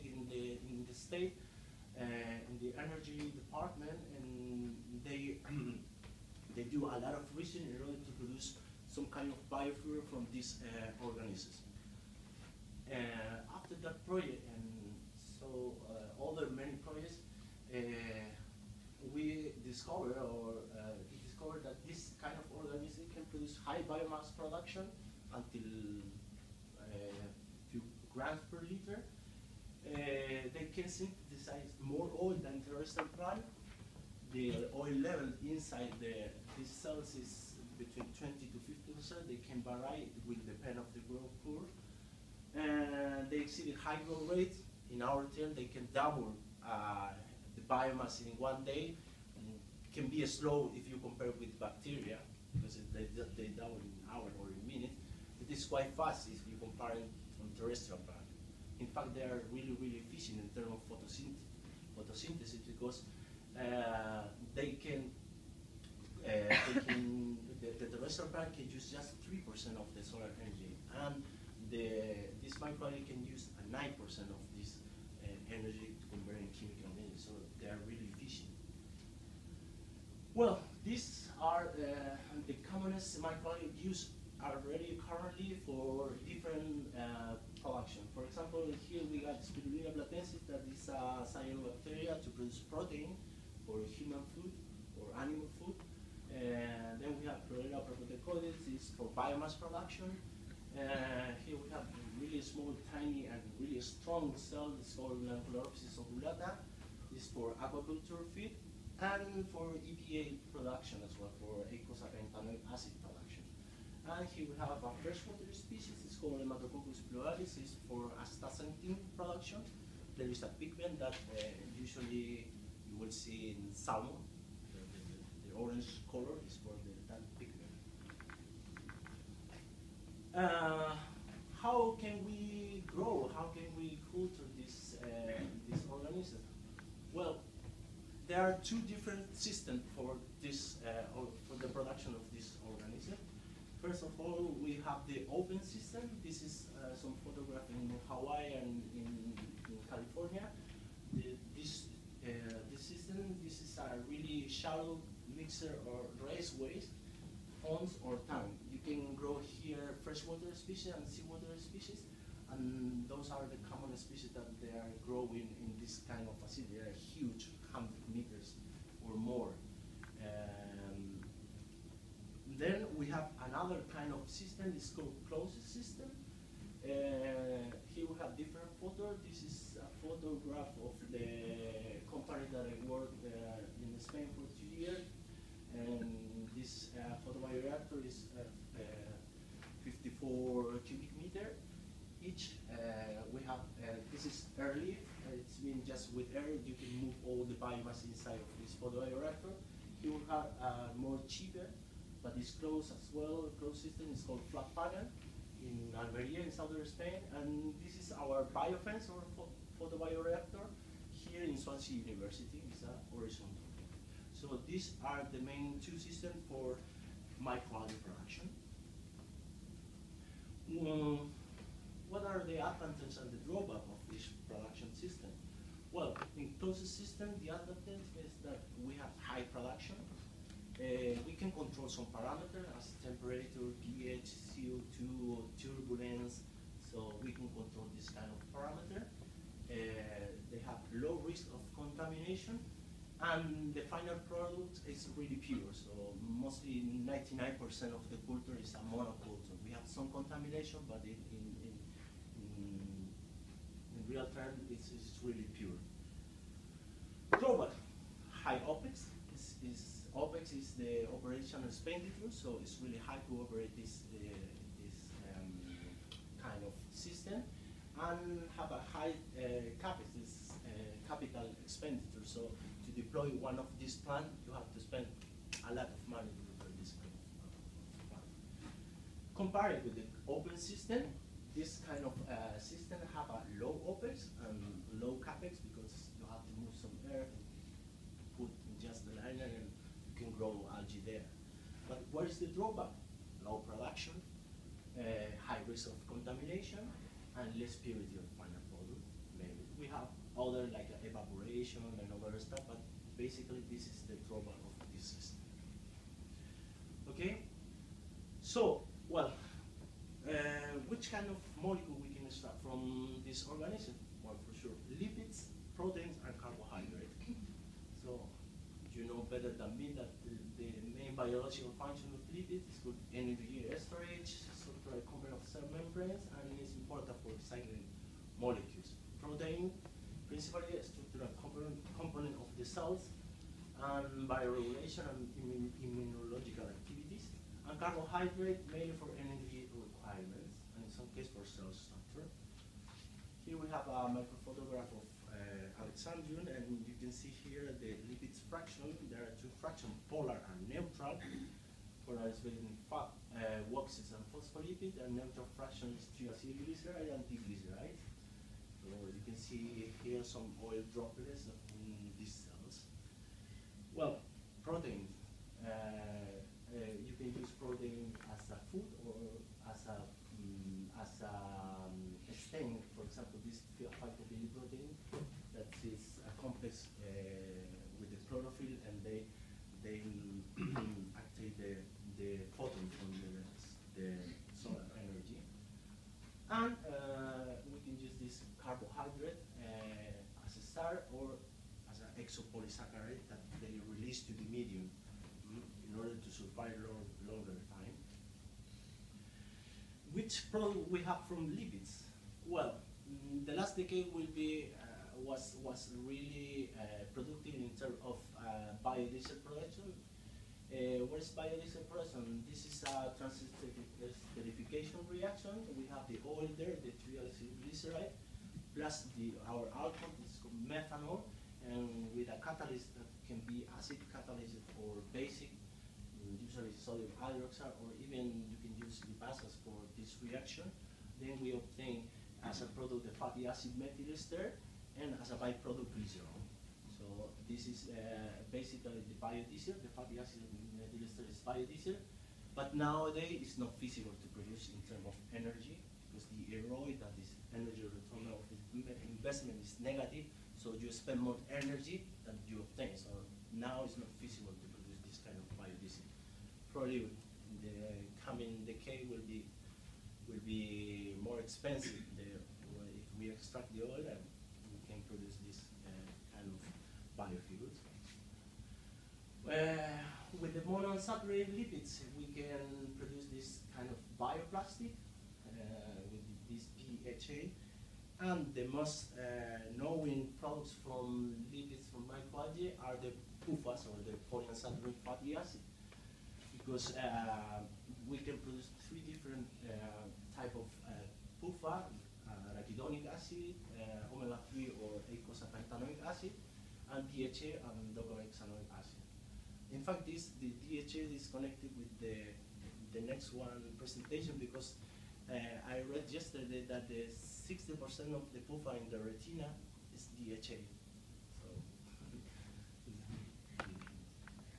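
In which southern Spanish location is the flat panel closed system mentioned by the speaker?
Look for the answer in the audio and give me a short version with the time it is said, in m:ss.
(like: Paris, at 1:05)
Almeria, at 3:25.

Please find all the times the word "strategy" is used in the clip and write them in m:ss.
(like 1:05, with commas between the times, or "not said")
not said.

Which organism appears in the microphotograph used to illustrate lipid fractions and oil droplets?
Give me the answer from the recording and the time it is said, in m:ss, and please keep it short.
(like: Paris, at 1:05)
Alexandrium, at 5:45.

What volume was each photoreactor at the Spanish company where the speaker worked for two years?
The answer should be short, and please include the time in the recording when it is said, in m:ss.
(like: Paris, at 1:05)
54 cubic meters, at 3:09.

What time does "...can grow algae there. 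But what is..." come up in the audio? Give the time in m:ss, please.
4:50.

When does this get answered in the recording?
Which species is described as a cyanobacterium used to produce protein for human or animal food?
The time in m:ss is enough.
1:29.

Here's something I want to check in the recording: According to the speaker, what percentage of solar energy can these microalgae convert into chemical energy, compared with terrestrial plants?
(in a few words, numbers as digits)
9%.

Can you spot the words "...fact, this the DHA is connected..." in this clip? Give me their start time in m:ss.
8:19.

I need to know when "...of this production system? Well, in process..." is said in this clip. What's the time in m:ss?
3:43.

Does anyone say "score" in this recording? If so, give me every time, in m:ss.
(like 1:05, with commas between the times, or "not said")
not said.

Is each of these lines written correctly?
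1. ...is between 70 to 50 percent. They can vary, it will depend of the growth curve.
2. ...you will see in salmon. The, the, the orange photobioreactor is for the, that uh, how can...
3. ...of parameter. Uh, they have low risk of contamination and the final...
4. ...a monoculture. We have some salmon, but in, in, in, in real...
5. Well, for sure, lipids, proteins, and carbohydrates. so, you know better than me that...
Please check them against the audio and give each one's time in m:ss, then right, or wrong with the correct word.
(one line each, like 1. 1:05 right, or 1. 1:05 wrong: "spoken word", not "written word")
1. 0:37 wrong: "20", not "70"
2. 2:02 wrong: "color", not "photobioreactor"
3. 3:58 right
4. 4:08 wrong: "contamination", not "salmon"
5. 5:14 right.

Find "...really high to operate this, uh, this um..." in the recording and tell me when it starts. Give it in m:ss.
4:22.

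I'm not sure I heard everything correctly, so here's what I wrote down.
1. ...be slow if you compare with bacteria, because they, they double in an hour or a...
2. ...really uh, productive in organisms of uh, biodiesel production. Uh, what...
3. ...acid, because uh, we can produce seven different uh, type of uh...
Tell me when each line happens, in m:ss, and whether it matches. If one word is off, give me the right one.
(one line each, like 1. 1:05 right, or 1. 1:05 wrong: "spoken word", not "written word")
1. 0:50 right
2. 6:46 wrong: "terms", not "organisms"
3. 8:05 wrong: "three", not "seven".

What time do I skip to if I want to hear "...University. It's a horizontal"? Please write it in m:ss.
3:32.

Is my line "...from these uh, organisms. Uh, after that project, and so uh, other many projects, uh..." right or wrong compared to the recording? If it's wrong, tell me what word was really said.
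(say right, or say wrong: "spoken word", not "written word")
right.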